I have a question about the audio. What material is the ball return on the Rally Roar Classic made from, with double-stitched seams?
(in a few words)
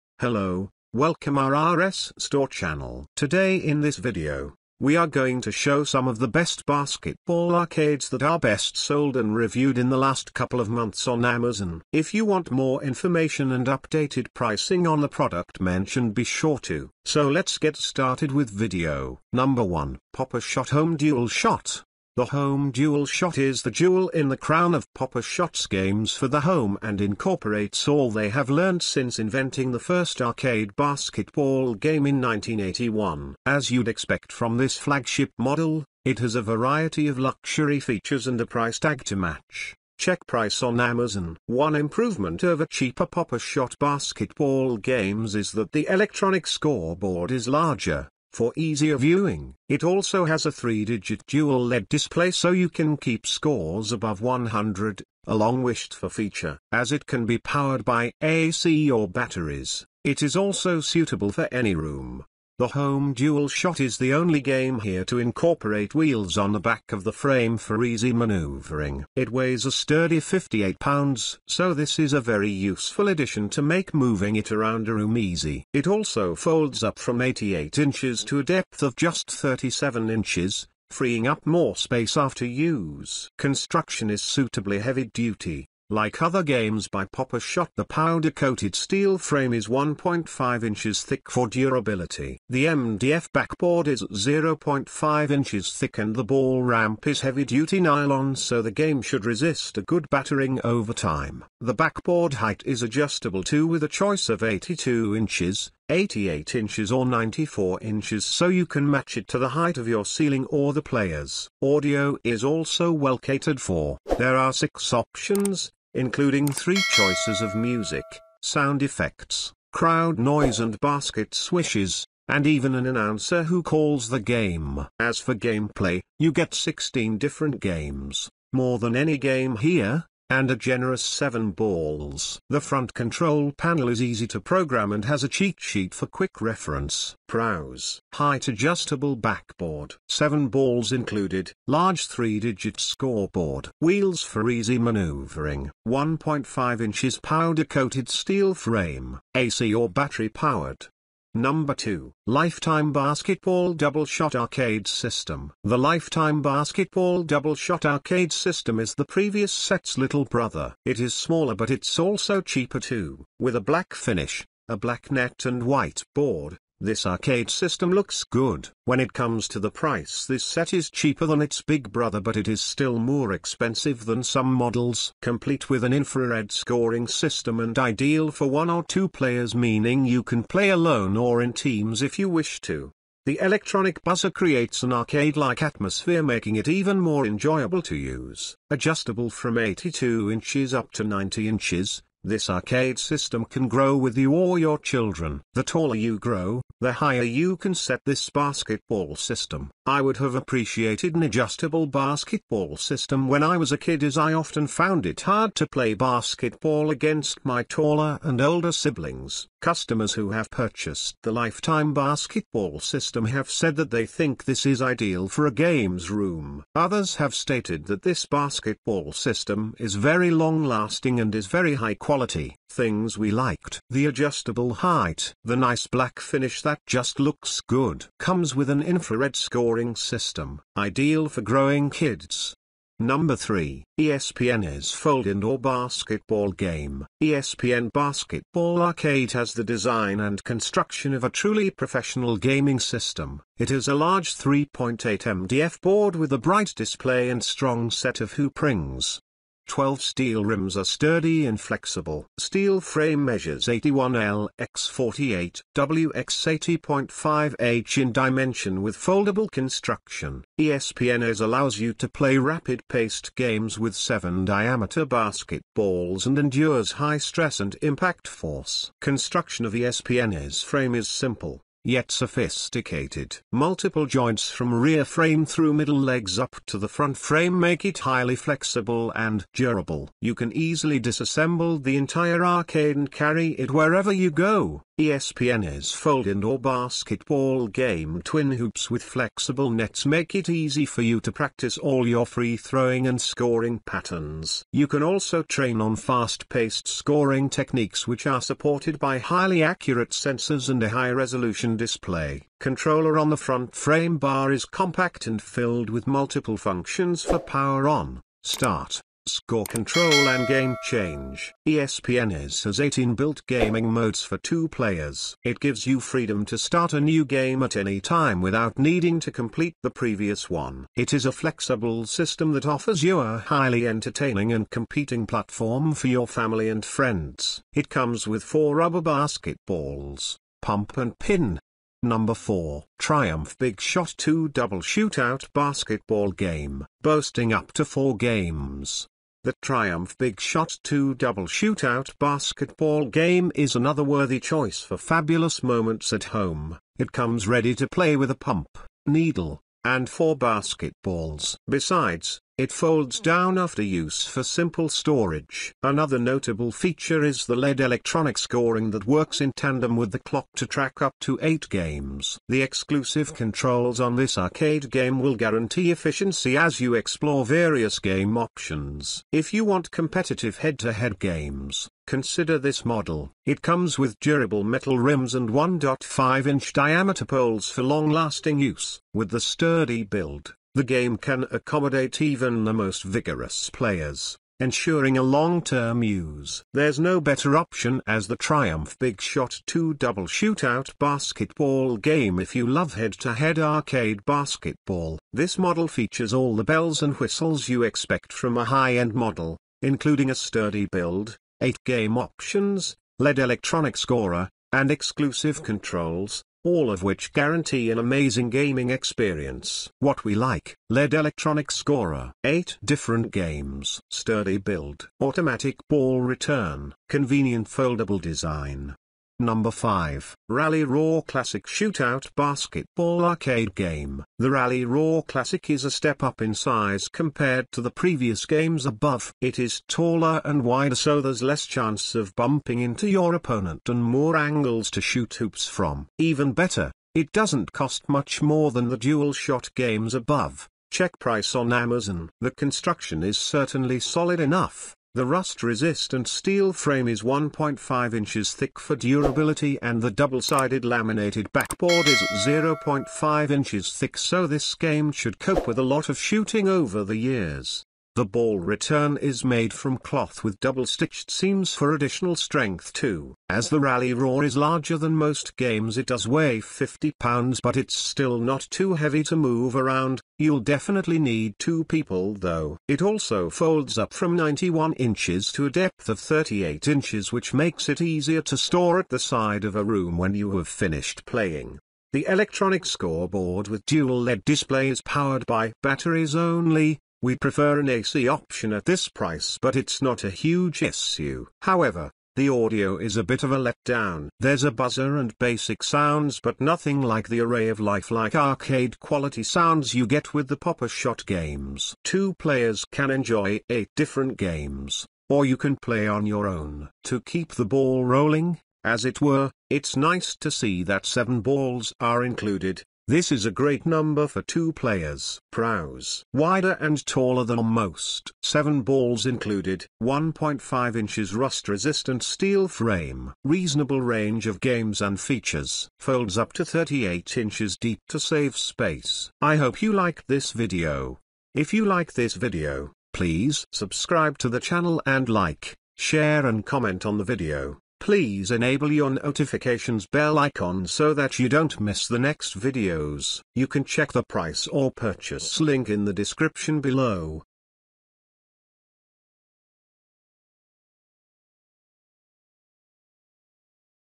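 Cloth.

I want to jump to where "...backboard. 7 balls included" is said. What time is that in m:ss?
2:19.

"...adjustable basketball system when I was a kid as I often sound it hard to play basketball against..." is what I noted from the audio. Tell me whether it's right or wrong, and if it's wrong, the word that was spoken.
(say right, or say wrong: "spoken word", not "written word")
wrong: "found", not "sound".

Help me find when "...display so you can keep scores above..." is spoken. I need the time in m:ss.
0:51.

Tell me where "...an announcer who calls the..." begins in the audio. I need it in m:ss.
2:02.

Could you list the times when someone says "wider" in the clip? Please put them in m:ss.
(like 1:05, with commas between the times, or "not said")
7:10, 8:36.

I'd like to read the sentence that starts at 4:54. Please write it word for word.
You can also train on fast-paced scoring techniques which are supported by highly accurate sensors and a high-resolution display.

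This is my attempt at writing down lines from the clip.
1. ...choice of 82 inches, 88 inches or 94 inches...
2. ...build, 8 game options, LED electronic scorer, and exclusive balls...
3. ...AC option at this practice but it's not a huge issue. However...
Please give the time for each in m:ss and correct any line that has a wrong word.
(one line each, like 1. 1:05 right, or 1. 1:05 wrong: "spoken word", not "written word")
1. 1:43 right
2. 6:40 wrong: "controls", not "balls"
3. 8:07 wrong: "price", not "practice".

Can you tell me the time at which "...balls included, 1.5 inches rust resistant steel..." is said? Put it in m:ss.
8:38.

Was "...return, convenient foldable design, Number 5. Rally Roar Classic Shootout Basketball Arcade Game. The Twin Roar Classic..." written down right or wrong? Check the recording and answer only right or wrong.
wrong.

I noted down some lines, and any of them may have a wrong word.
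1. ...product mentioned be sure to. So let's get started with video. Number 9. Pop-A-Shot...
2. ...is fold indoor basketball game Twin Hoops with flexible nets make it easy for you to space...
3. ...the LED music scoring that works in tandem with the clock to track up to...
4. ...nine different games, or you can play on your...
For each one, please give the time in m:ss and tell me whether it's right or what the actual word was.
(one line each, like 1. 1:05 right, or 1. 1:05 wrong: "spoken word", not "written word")
1. 0:15 wrong: "1", not "9"
2. 4:45 wrong: "practice", not "space"
3. 5:57 wrong: "electronic", not "music"
4. 8:23 wrong: "eight", not "nine".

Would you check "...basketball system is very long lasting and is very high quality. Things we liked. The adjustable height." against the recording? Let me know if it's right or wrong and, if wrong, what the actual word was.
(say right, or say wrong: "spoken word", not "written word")
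right.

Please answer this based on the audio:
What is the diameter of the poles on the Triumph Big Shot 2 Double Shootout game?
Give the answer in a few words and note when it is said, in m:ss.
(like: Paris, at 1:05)
1.5 inches, at 6:15.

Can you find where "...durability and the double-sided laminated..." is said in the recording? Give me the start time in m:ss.
7:28.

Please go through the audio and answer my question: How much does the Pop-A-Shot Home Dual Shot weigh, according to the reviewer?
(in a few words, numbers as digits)
58 pounds.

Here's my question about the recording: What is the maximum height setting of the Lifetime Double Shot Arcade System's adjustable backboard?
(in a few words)
90 inches.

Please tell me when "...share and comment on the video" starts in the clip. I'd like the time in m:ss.
8:55.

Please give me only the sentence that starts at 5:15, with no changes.
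It gives you freedom to start a new game at any time without needing to complete the previous one.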